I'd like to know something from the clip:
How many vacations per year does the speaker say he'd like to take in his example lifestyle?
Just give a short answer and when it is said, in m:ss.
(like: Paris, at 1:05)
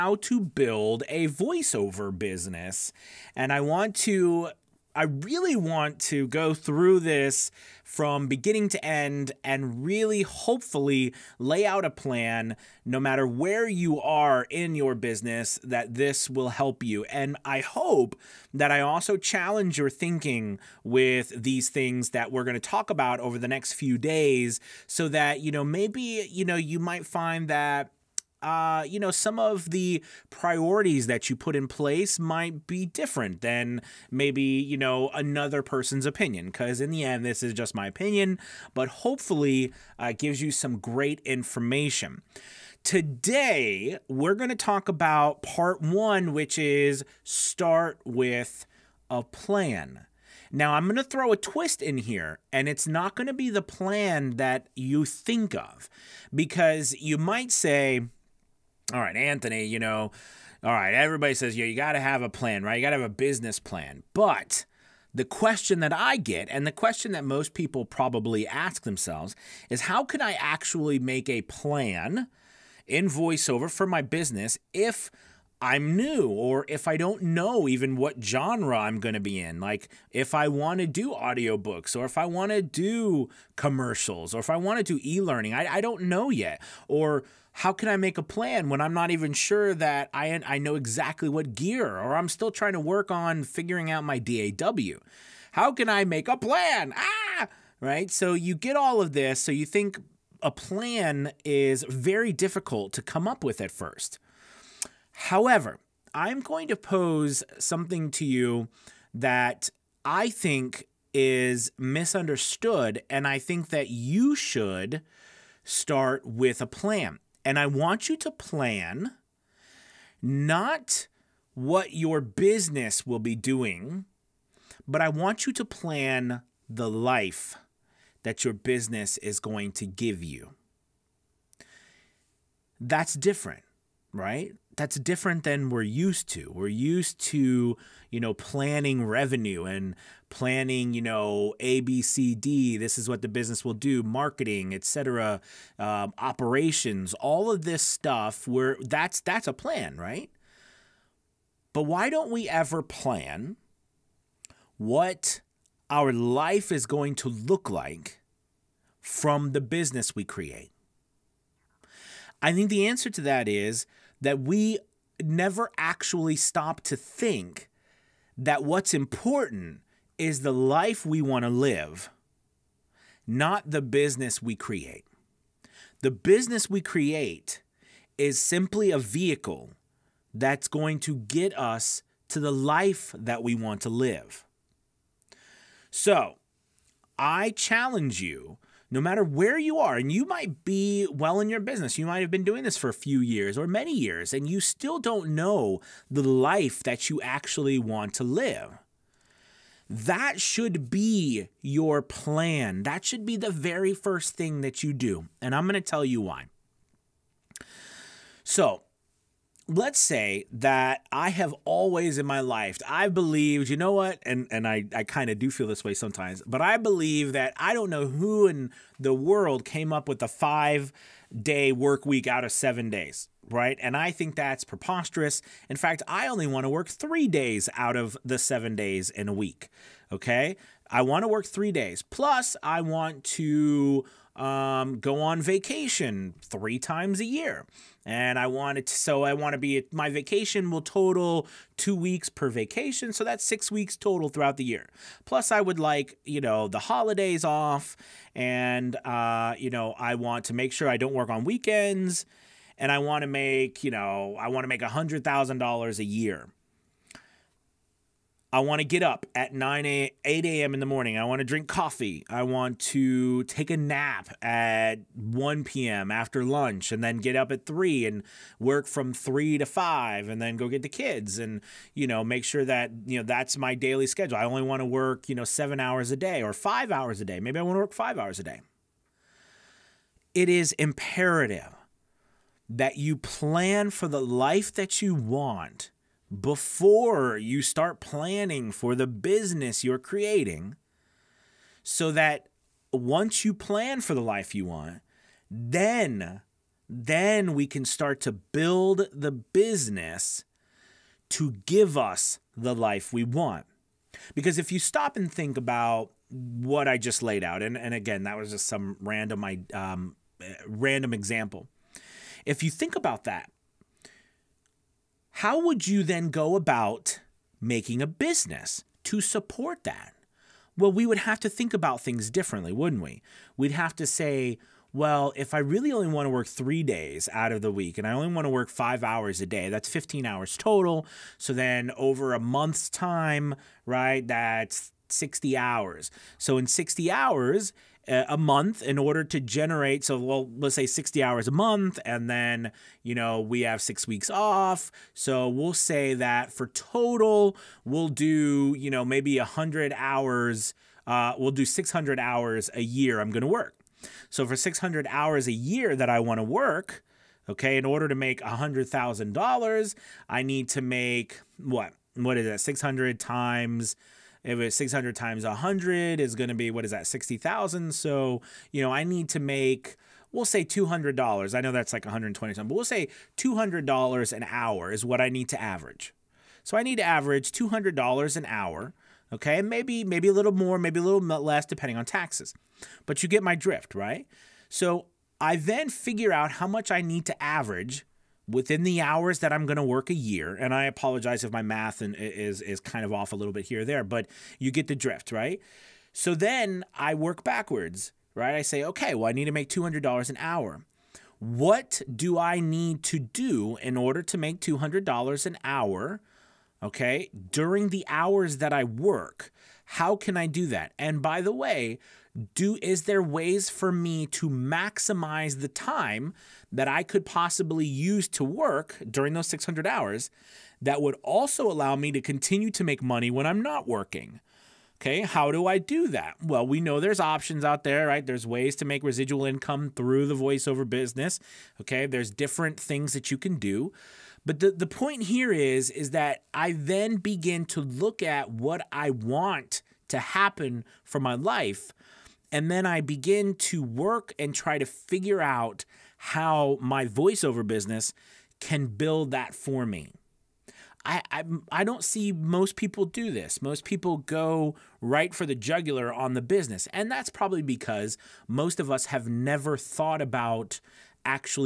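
3, at 3:56.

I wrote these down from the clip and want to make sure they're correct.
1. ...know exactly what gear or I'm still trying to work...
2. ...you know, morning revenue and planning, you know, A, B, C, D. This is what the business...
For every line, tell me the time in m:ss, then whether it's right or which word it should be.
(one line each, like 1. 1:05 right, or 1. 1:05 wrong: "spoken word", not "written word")
1. 1:30 right
2. 2:18 wrong: "planning", not "morning".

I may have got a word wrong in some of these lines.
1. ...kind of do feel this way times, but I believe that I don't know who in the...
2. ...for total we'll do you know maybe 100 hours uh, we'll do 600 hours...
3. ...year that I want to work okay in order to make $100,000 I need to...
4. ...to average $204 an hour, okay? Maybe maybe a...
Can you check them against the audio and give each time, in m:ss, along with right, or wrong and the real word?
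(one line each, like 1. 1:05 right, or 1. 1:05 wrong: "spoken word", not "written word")
1. 3:35 wrong: "sometimes", not "times"
2. 5:46 right
3. 5:55 right
4. 6:16 wrong: "200", not "204".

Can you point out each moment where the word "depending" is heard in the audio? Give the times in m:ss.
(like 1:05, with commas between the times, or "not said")
6:21.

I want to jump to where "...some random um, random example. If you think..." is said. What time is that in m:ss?
5:08.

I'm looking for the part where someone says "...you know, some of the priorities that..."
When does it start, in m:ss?
0:28.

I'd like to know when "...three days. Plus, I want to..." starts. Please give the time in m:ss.
3:51.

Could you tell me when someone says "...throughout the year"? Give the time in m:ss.
4:04.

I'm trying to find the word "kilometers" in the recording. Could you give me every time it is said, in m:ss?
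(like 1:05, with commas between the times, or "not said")
not said.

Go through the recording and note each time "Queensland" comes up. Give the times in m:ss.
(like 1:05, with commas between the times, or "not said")
not said.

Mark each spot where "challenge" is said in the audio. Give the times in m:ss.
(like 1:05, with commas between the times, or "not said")
0:19, 3:07.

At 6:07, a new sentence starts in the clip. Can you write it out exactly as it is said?
So, you know, I need to make we'll say $200.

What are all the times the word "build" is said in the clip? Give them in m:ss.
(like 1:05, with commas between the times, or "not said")
0:00, 4:58, 7:28.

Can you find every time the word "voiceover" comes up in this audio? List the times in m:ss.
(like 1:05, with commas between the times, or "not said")
0:01, 1:13, 7:10, 7:27.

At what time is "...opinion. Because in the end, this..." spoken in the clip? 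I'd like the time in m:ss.
0:36.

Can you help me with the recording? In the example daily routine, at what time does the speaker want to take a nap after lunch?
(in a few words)
1 p.m.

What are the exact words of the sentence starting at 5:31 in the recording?
So then over a month's time, right, that's 60 hours.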